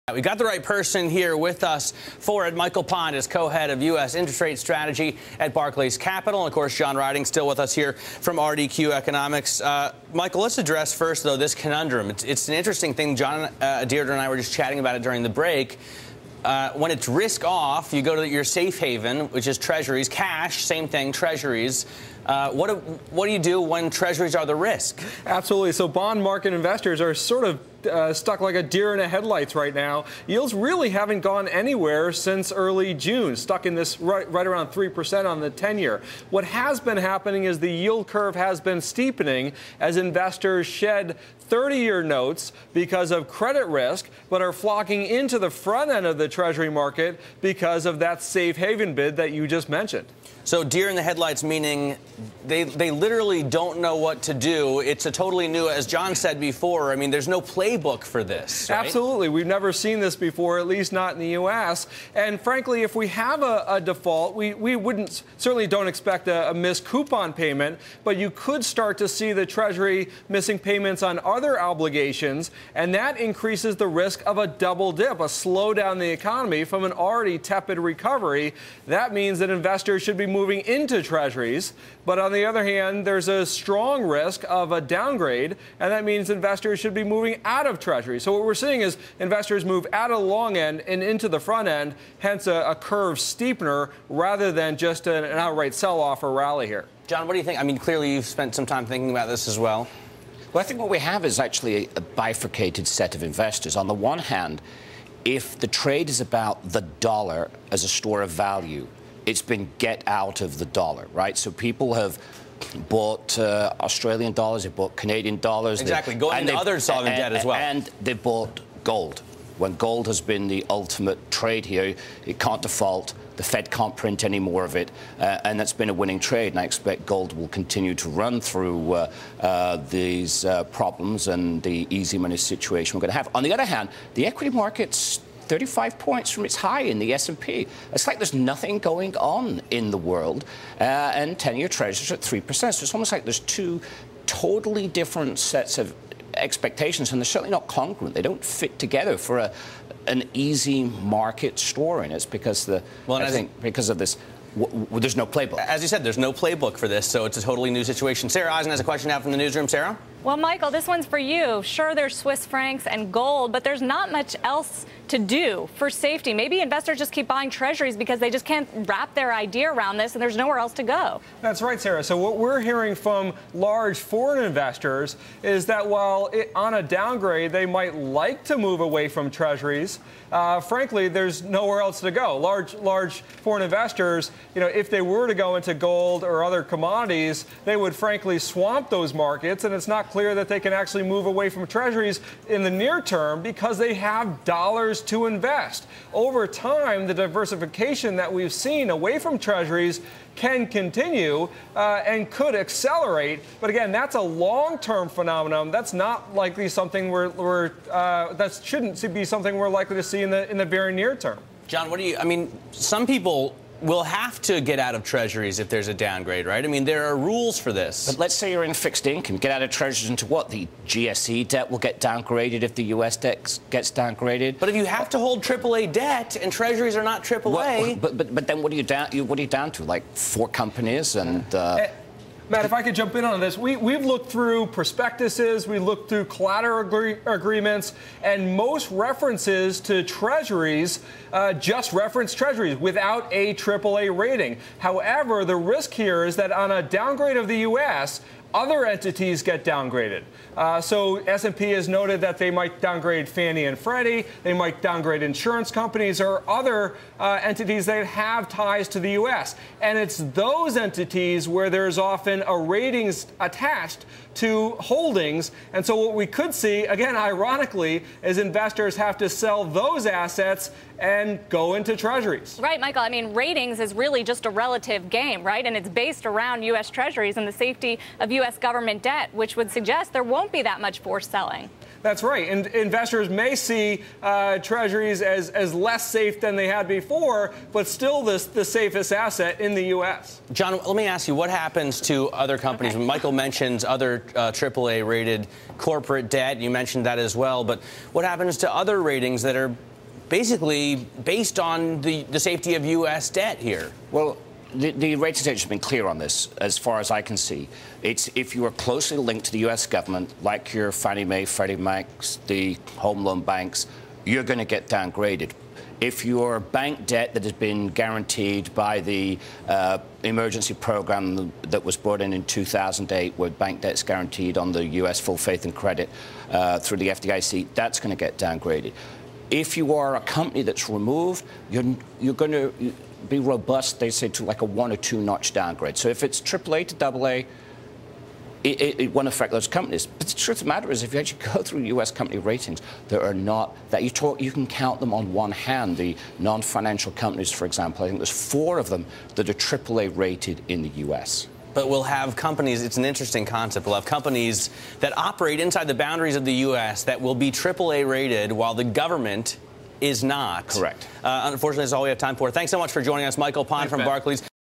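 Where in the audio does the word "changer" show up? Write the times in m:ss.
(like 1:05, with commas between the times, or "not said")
not said.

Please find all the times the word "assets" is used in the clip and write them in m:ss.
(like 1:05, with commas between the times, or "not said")
4:30, 4:49.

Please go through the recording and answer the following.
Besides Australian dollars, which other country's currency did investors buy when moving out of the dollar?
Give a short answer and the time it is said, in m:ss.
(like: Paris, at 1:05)
Canadian dollars, at 1:54.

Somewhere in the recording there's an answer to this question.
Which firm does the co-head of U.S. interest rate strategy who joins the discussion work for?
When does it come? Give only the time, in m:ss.
0:05.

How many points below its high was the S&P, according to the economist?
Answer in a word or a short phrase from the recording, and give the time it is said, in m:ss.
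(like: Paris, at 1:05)
35, at 2:15.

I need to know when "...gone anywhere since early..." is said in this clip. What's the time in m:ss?
0:31.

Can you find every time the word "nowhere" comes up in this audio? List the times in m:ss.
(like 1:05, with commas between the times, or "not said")
2:50, 3:01.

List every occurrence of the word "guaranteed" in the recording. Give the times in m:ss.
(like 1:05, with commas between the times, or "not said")
5:17, 5:24.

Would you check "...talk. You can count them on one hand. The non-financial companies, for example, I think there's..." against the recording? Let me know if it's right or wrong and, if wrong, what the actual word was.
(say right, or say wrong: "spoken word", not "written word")
right.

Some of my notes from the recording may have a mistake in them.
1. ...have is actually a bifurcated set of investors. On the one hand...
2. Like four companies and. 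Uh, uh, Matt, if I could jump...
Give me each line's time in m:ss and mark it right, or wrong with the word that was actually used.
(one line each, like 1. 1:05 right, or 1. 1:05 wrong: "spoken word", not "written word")
1. 1:40 right
2. 3:49 right.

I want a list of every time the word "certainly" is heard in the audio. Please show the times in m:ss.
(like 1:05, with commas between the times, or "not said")
1:05, 2:27.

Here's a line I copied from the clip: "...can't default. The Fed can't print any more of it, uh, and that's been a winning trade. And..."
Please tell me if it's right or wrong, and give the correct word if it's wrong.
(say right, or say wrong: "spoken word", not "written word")
right.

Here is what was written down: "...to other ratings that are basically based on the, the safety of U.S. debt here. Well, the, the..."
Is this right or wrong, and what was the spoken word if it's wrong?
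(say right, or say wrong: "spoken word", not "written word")
right.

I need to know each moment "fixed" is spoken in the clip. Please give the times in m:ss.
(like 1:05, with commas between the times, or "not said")
3:38.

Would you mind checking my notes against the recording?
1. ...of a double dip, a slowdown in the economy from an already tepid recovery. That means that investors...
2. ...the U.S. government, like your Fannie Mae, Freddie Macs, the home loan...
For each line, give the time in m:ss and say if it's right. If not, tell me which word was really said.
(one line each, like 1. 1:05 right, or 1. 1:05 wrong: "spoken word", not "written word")
1. 1:14 right
2. 5:09 right.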